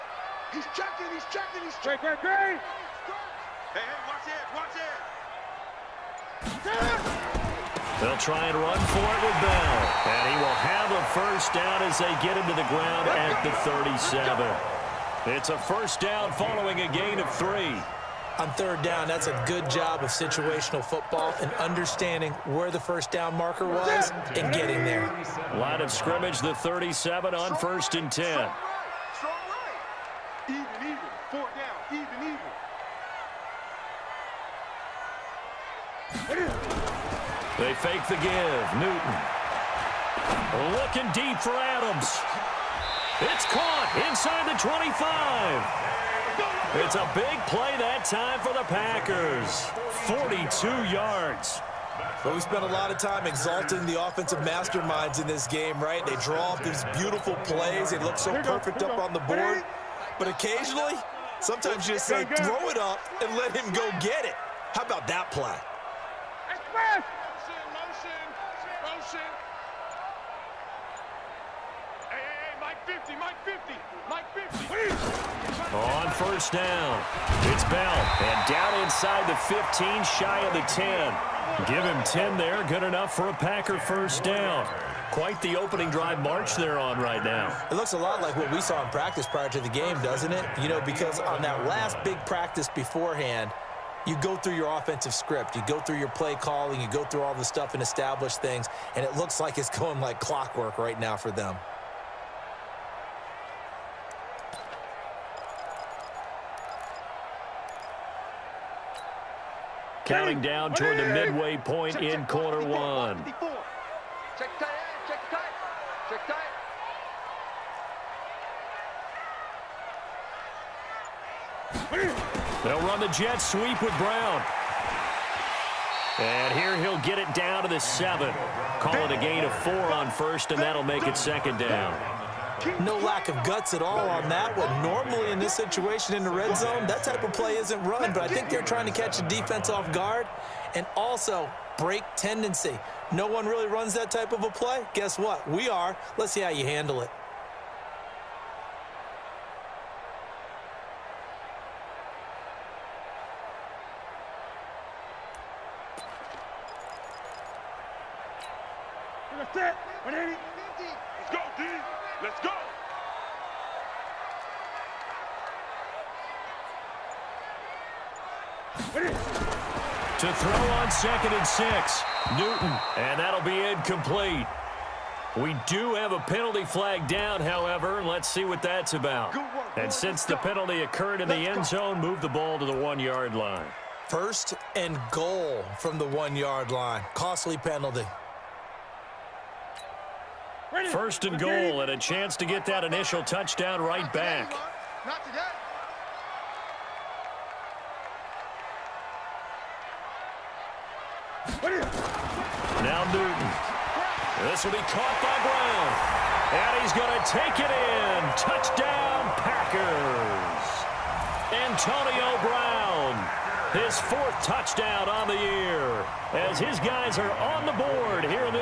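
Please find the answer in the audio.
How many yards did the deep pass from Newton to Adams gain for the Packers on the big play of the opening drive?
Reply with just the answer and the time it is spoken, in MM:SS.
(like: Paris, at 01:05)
42, at 00:50.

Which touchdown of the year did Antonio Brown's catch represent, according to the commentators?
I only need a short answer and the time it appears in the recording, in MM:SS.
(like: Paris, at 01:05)
4th, at 03:33.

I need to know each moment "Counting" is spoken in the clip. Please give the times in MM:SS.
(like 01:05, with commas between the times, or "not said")
01:50.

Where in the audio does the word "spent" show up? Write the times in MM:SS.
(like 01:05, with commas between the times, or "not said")
00:52.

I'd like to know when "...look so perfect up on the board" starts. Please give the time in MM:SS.
00:57.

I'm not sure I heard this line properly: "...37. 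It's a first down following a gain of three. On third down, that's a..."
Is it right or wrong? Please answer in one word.
right.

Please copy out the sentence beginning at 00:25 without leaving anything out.
Line of scrimmage, the 37 on first and 10.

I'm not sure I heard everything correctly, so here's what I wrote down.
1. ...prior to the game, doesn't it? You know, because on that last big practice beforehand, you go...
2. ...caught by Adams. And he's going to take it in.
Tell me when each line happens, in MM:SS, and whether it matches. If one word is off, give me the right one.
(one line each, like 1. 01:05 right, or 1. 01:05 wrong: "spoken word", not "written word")
1. 01:29 right
2. 03:24 wrong: "Brown", not "Adams".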